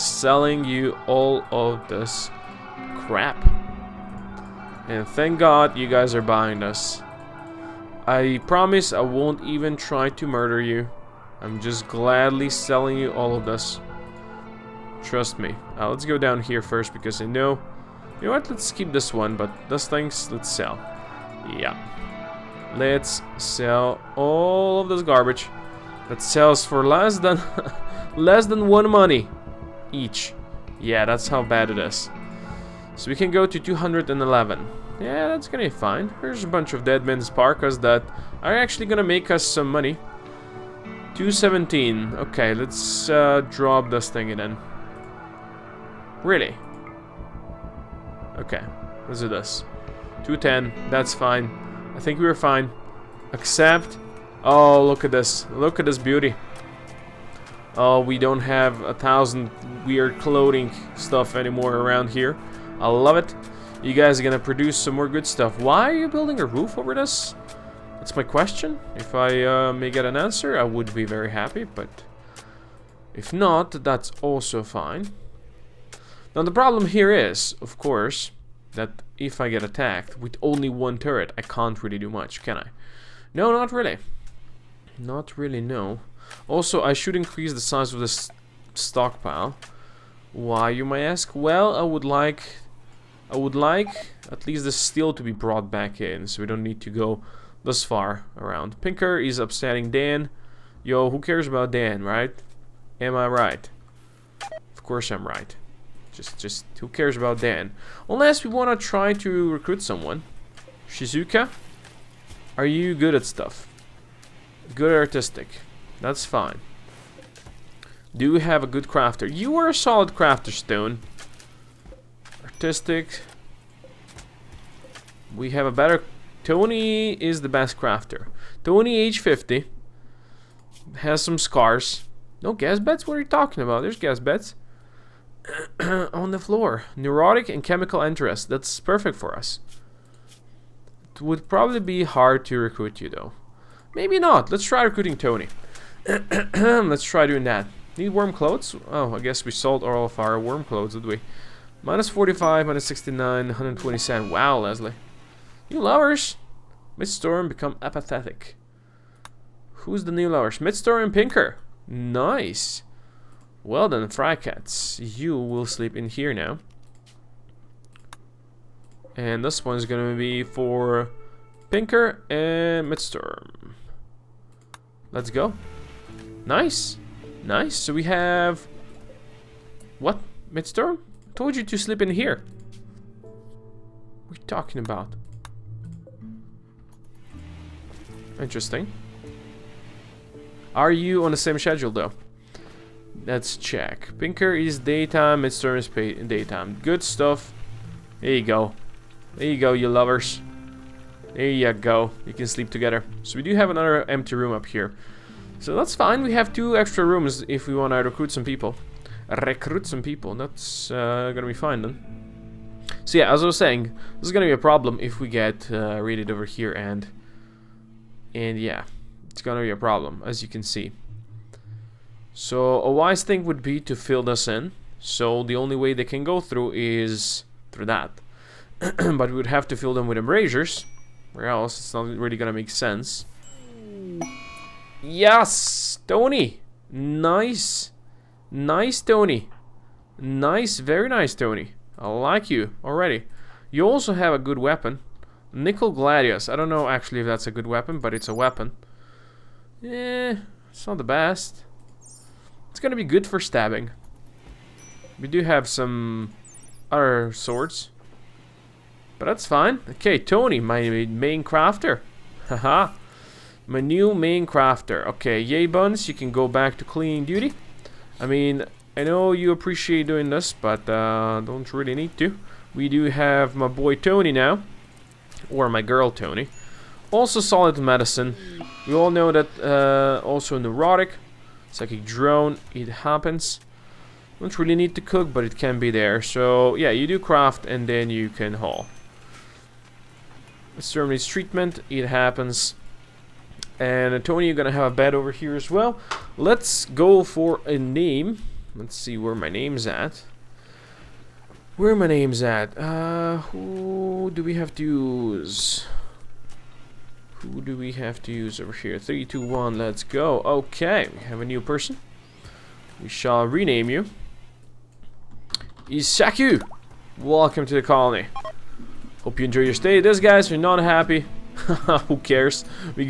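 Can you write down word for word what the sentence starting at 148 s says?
Oh, I guess we sold all of our warm clothes, did we?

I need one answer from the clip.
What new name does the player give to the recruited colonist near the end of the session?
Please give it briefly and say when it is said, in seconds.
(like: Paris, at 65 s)
Isaku, at 315 s.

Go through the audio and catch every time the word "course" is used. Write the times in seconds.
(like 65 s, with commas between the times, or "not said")
77 s, 104 s.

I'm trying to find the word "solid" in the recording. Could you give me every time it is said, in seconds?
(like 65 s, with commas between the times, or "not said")
119 s, 277 s.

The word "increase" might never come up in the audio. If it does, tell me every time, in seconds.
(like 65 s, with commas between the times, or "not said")
87 s.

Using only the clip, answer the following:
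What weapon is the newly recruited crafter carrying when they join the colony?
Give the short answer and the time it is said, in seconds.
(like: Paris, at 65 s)
Nickel Gladius, at 245 s.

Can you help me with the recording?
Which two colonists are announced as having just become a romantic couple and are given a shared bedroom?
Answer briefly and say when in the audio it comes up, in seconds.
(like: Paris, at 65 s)
Midstorm and Pinker, at 160 s.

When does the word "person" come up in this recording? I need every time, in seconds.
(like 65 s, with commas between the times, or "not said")
311 s.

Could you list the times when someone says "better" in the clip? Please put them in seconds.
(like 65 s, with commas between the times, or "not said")
125 s.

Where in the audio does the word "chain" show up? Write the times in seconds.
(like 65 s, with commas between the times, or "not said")
not said.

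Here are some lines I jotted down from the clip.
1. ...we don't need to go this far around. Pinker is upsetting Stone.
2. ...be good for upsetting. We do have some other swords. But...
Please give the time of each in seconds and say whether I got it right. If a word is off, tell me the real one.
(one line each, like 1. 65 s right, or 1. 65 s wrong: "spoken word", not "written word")
1. 96 s wrong: "Dan", not "Stone"
2. 252 s wrong: "stabbing", not "upsetting".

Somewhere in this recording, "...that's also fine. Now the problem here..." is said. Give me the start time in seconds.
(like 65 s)
73 s.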